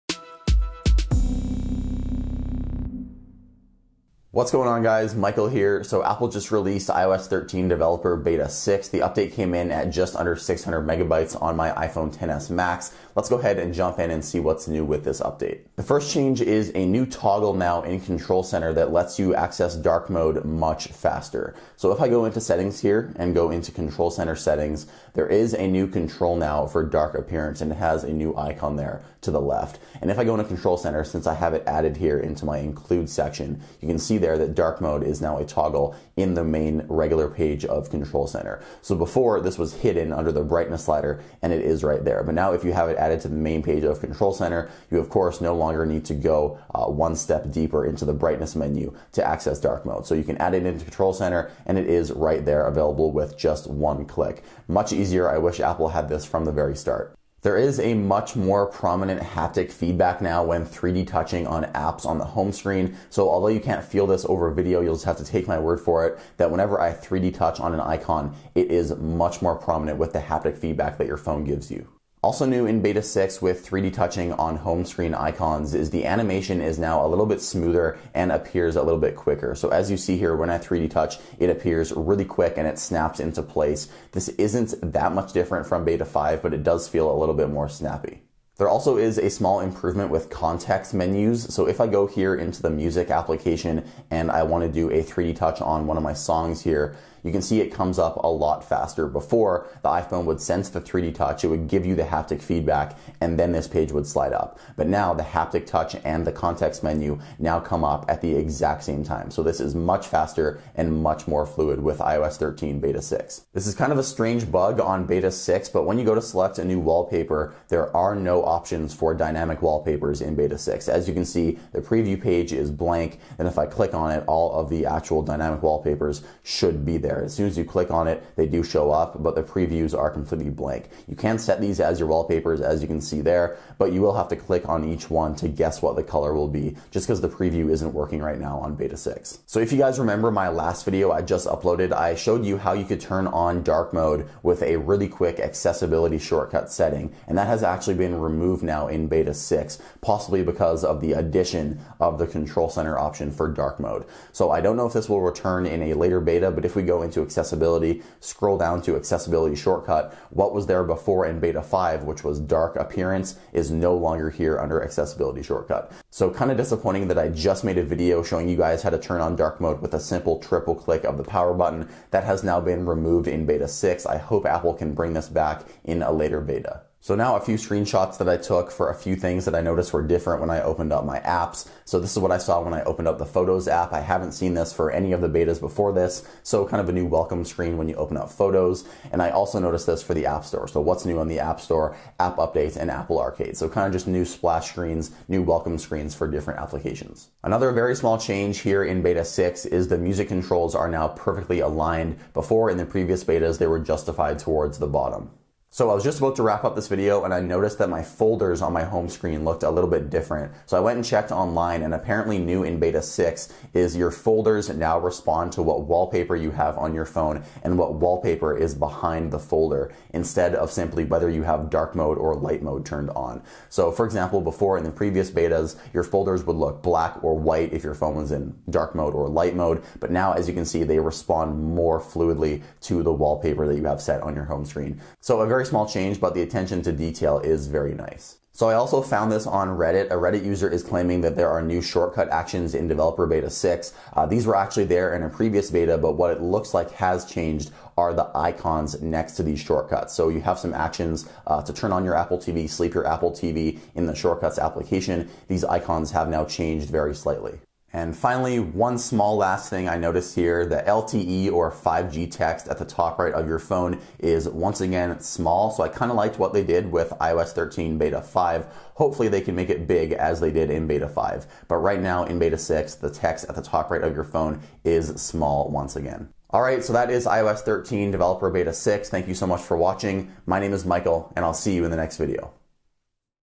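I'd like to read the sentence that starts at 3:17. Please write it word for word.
Another very small change here in beta 6 is the music controls are now perfectly aligned.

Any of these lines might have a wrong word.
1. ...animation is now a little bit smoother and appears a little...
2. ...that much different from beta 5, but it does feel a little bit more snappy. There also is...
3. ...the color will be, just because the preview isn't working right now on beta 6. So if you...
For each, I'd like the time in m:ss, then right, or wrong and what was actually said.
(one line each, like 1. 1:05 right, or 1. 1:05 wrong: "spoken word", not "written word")
1. 1:16 right
2. 1:24 right
3. 2:15 right.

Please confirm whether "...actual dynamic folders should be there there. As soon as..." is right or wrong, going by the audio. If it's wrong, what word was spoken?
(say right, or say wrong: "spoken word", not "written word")
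wrong: "wallpapers", not "folders".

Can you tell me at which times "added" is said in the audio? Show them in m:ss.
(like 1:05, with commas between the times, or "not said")
0:31, 0:42.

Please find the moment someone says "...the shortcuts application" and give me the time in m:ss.
4:14.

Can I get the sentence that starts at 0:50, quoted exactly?
So you can add it into Control Center and it is right there available with just one click.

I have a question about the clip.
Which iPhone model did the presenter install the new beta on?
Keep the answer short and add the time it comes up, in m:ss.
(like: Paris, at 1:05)
iPhone XS Max, at 0:11.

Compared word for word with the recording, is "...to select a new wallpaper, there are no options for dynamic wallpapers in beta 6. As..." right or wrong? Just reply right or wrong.
right.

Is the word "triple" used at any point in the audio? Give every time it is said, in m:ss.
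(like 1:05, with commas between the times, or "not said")
2:50.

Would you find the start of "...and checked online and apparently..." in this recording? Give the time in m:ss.
3:30.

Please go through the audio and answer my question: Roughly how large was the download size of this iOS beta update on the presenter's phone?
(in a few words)
just under 600 megabytes.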